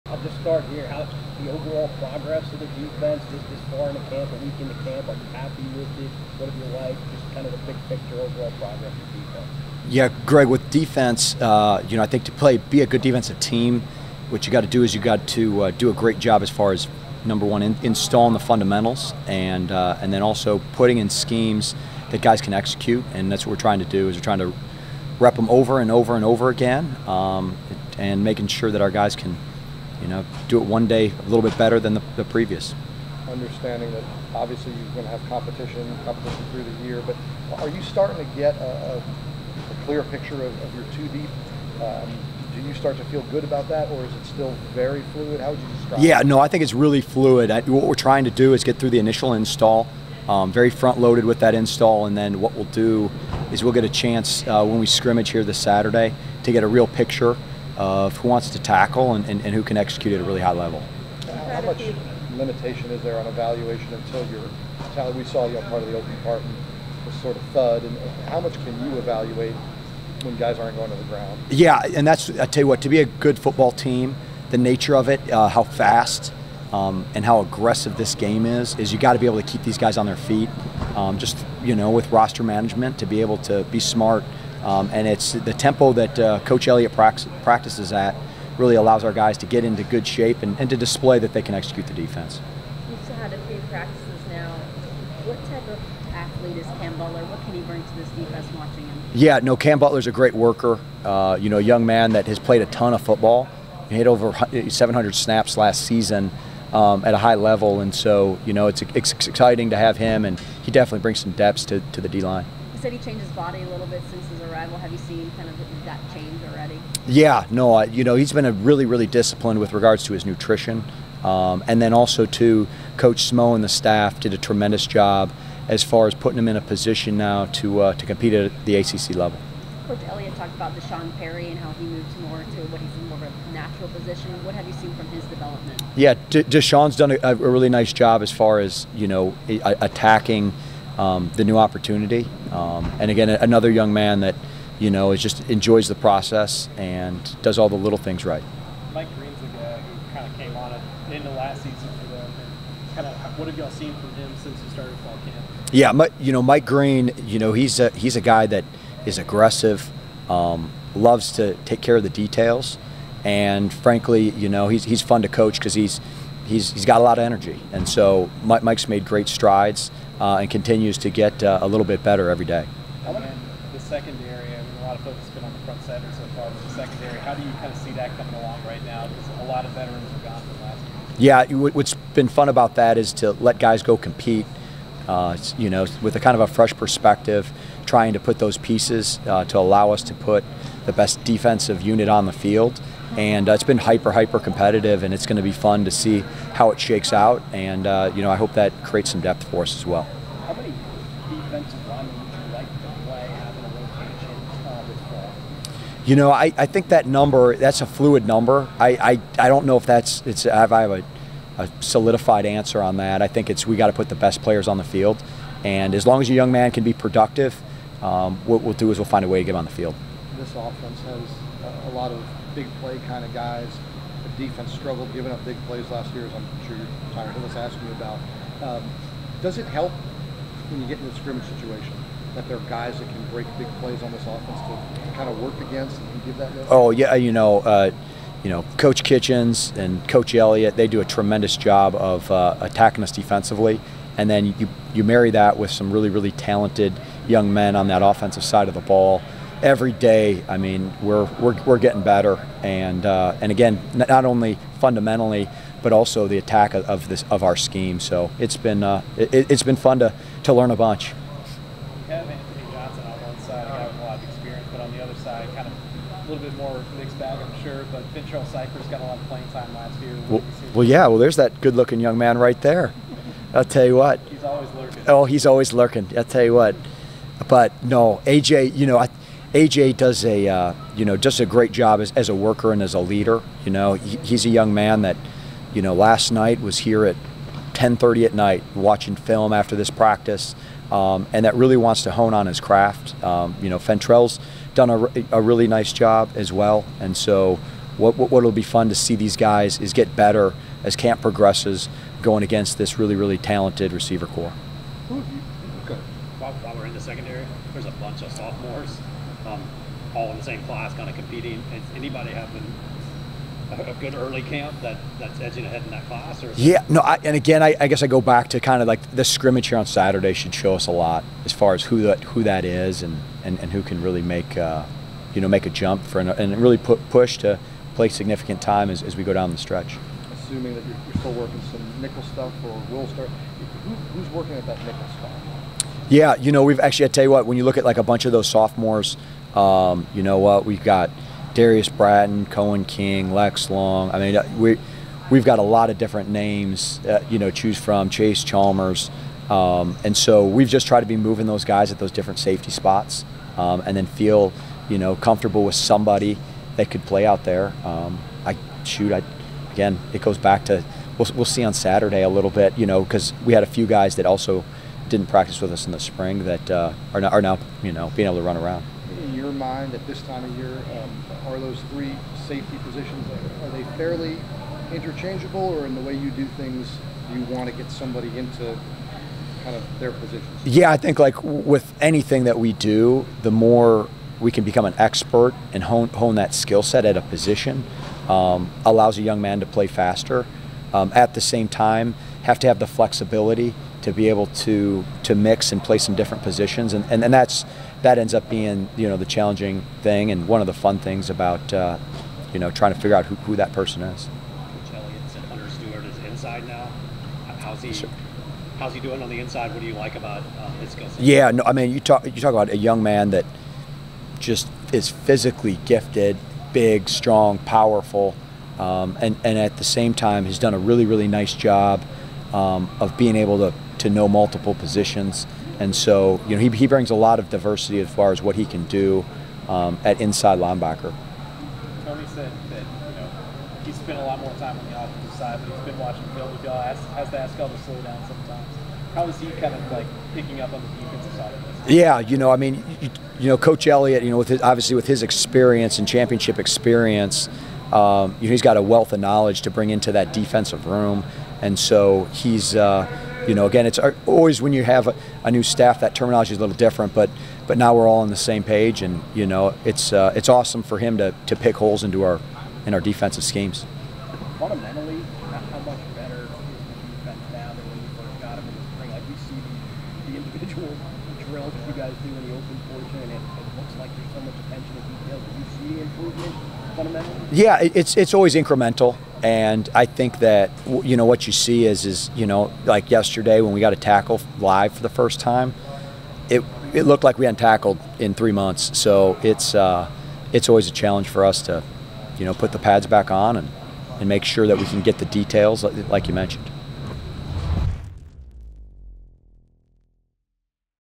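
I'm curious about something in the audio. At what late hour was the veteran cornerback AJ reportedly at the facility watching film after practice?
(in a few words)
10:30 at night.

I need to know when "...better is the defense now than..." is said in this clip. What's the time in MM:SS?
07:46.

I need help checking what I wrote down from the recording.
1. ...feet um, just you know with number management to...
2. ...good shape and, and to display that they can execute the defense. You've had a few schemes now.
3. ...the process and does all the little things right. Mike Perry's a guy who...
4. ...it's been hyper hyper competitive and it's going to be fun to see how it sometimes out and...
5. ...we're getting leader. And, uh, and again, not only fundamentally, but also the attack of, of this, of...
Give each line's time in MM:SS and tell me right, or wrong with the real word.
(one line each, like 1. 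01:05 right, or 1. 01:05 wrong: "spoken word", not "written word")
1. 01:20 wrong: "roster", not "number"
2. 01:29 wrong: "practices", not "schemes"
3. 02:25 wrong: "Green", not "Perry"
4. 03:13 wrong: "shakes", not "sometimes"
5. 04:11 wrong: "better", not "leader".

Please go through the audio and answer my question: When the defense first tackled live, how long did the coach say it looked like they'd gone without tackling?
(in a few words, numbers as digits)
3 months.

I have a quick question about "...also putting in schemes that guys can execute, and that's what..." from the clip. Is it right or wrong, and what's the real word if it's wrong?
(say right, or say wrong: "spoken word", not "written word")
right.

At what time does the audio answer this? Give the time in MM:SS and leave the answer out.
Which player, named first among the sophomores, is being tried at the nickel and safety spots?
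05:41.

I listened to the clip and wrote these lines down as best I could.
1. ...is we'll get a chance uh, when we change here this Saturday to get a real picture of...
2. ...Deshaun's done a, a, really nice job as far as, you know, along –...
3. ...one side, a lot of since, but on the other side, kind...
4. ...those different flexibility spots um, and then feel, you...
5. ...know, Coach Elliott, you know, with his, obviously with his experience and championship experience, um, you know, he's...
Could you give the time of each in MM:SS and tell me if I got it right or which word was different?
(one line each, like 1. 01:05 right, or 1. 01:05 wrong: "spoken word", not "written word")
1. 00:53 wrong: "scrimmage", not "change"
2. 02:16 wrong: "attacking", not "along"
3. 04:23 wrong: "experience", not "since"
4. 05:51 wrong: "safety", not "flexibility"
5. 07:23 right.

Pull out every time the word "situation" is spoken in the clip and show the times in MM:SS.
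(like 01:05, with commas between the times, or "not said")
03:51.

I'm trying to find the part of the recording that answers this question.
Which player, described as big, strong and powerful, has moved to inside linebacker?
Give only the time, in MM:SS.
06:45.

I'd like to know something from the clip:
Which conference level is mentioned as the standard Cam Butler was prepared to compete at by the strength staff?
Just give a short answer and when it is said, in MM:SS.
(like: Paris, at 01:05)
ACC, at 02:08.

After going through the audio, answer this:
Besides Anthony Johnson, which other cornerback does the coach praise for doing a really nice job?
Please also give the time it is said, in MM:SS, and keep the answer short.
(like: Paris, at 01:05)
Fentrell, at 04:53.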